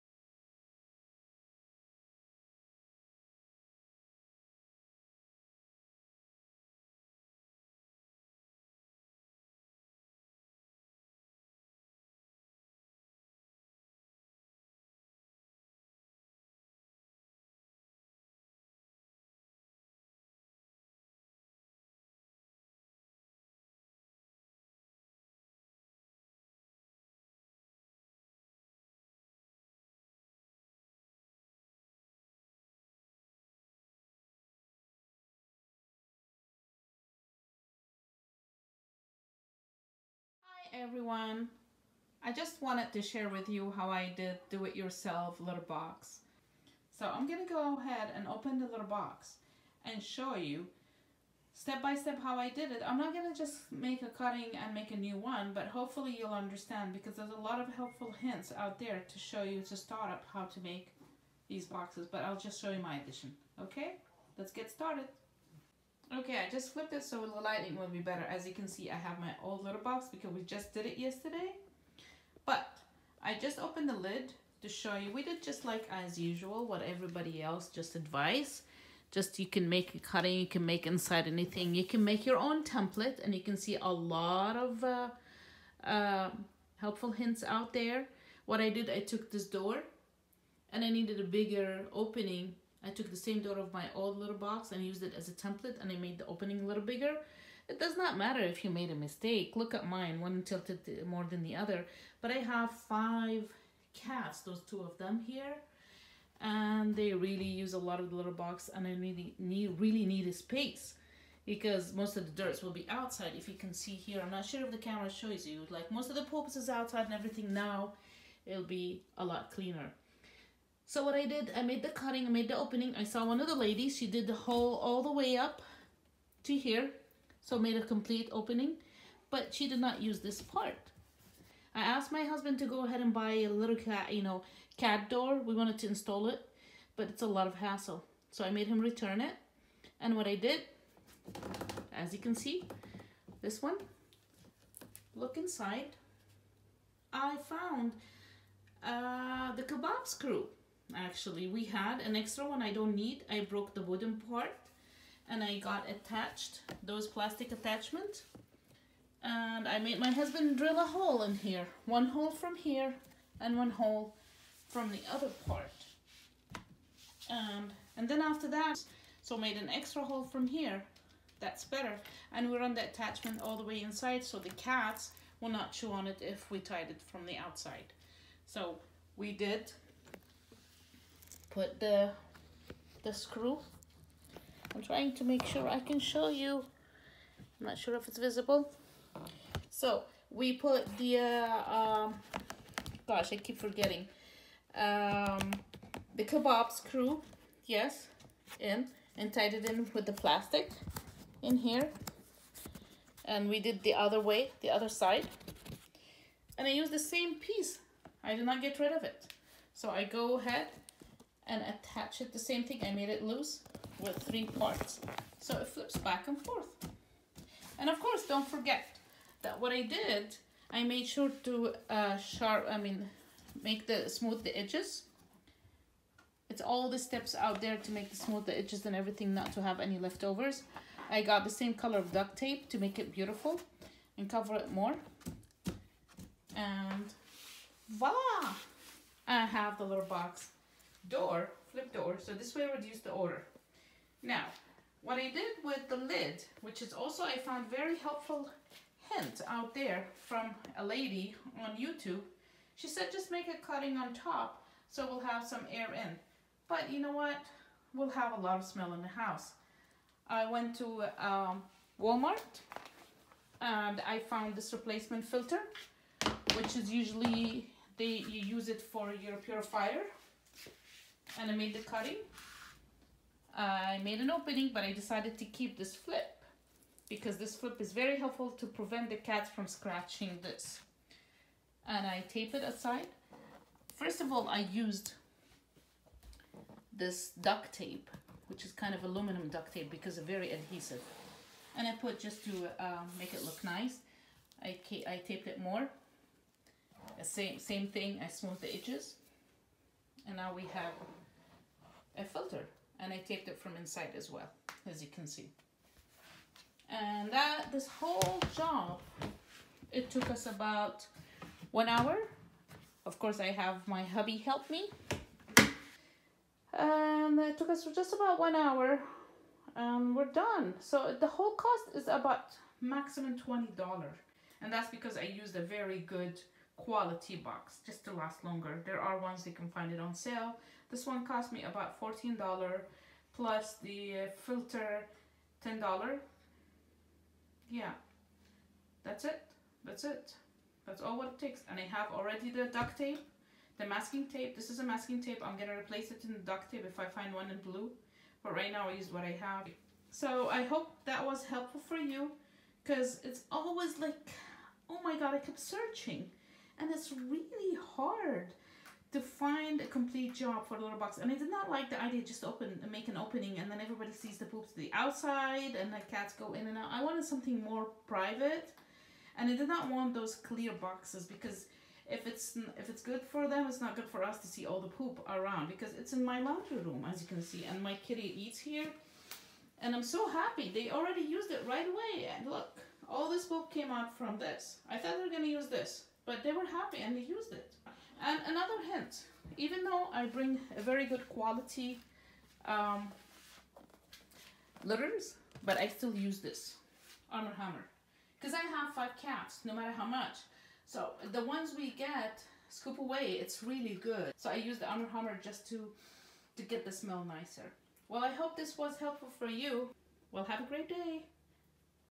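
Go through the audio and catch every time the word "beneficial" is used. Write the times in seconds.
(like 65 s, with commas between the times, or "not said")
not said.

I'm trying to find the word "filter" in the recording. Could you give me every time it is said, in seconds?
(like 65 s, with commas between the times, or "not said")
265 s, 302 s, 334 s.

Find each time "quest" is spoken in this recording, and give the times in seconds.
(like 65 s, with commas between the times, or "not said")
not said.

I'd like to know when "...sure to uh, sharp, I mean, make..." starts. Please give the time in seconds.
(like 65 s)
221 s.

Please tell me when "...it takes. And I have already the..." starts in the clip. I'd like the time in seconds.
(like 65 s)
341 s.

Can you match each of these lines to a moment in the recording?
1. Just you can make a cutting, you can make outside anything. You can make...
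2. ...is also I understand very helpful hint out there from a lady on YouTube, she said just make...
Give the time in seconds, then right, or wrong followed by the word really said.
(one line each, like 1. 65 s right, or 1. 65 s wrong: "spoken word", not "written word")
1. 79 s wrong: "inside", not "outside"
2. 246 s wrong: "found", not "understand".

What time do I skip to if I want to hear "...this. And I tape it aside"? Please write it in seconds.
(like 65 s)
280 s.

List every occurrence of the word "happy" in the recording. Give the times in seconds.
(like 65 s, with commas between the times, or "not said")
380 s, 386 s.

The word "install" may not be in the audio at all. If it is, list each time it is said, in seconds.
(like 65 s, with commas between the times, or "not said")
135 s.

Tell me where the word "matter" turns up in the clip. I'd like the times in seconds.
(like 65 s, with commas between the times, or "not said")
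98 s, 399 s.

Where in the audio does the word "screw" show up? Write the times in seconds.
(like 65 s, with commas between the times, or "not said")
150 s, 183 s, 196 s.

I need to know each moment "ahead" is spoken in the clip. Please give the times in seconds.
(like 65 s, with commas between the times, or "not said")
47 s, 132 s, 210 s.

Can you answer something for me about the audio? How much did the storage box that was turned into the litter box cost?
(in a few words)
$14.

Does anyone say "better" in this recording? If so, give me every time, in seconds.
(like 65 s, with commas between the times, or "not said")
67 s, 171 s.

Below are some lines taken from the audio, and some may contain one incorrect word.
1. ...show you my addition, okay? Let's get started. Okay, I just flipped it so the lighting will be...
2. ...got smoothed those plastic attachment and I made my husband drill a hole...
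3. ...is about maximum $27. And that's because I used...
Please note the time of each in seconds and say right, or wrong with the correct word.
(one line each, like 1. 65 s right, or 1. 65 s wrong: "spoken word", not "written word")
1. 62 s right
2. 155 s wrong: "attached", not "smoothed"
3. 321 s wrong: "20", not "27".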